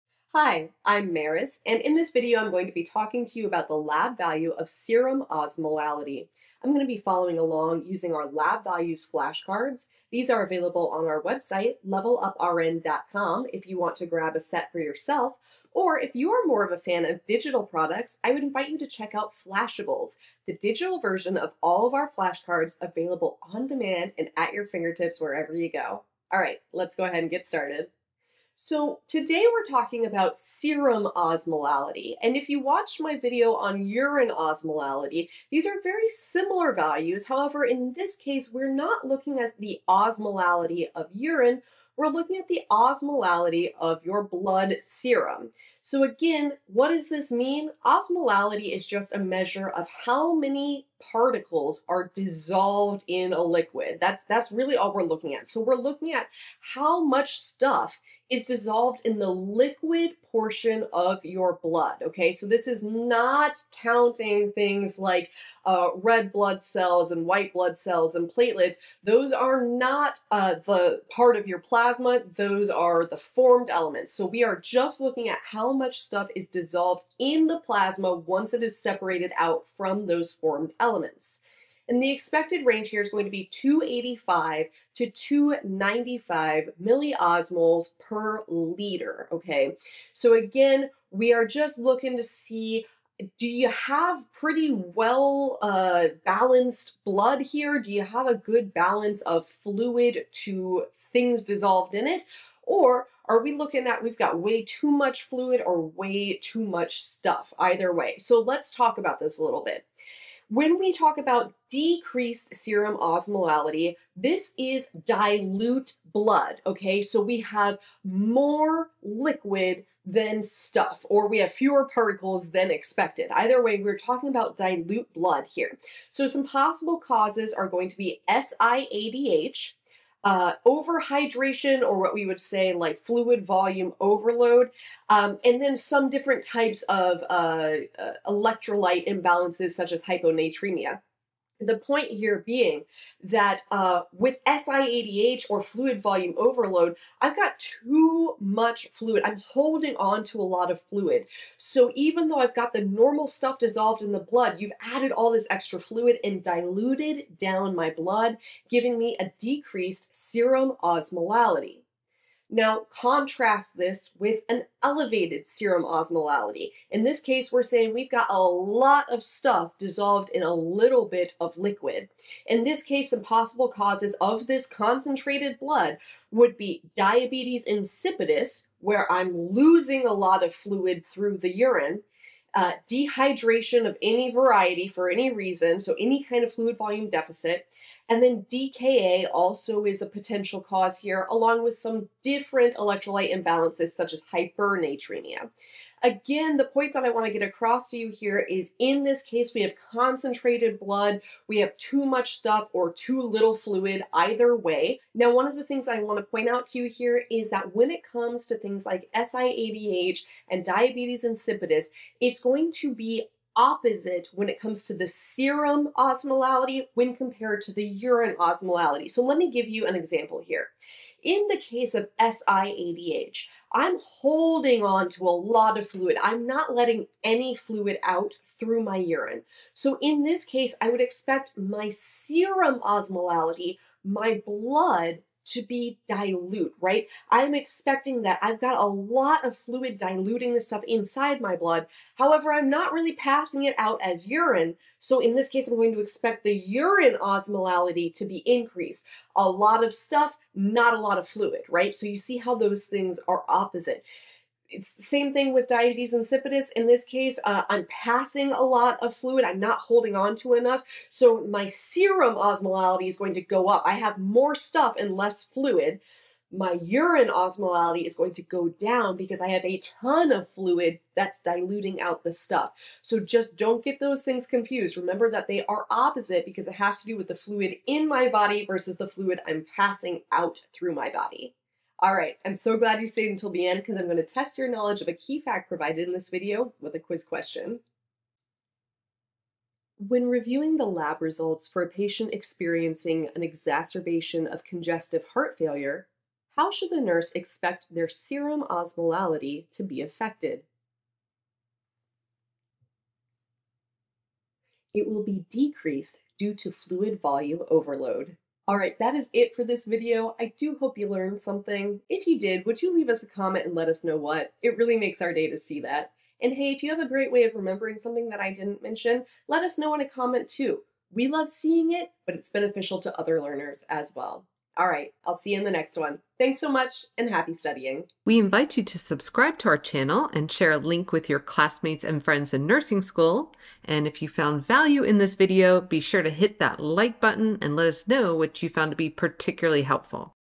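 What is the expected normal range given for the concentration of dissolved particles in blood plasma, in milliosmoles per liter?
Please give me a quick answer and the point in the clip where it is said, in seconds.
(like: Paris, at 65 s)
285 to 295, at 83 s.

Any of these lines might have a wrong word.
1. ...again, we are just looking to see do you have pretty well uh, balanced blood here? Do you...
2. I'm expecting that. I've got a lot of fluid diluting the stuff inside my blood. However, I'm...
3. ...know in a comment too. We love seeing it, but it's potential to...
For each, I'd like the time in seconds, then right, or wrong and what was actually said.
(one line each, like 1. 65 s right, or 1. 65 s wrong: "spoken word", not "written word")
1. 90 s right
2. 237 s right
3. 319 s wrong: "beneficial", not "potential".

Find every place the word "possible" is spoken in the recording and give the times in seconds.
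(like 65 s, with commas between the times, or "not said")
126 s, 173 s.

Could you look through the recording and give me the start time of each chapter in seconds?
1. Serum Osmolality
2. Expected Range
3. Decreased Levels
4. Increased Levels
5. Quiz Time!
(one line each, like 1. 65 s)
1. 28 s
2. 81 s
3. 112 s
4. 164 s
5. 287 s.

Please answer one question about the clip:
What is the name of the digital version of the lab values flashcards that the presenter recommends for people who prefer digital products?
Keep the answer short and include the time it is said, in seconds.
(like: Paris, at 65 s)
Flashables, at 19 s.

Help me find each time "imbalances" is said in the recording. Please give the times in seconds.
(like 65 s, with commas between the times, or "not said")
139 s, 193 s.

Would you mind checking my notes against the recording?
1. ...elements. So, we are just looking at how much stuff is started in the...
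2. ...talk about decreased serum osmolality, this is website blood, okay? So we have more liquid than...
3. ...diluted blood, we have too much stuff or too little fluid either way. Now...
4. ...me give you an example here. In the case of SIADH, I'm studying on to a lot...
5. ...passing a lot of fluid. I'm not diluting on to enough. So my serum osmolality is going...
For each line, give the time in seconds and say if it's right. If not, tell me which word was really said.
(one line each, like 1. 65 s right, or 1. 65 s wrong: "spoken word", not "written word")
1. 73 s wrong: "dissolved", not "started"
2. 110 s wrong: "dilute", not "website"
3. 199 s wrong: "concentrated", not "diluted"
4. 219 s wrong: "holding", not "studying"
5. 257 s wrong: "holding", not "diluting".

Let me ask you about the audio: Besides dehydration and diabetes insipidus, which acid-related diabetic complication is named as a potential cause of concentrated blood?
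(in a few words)
DKA.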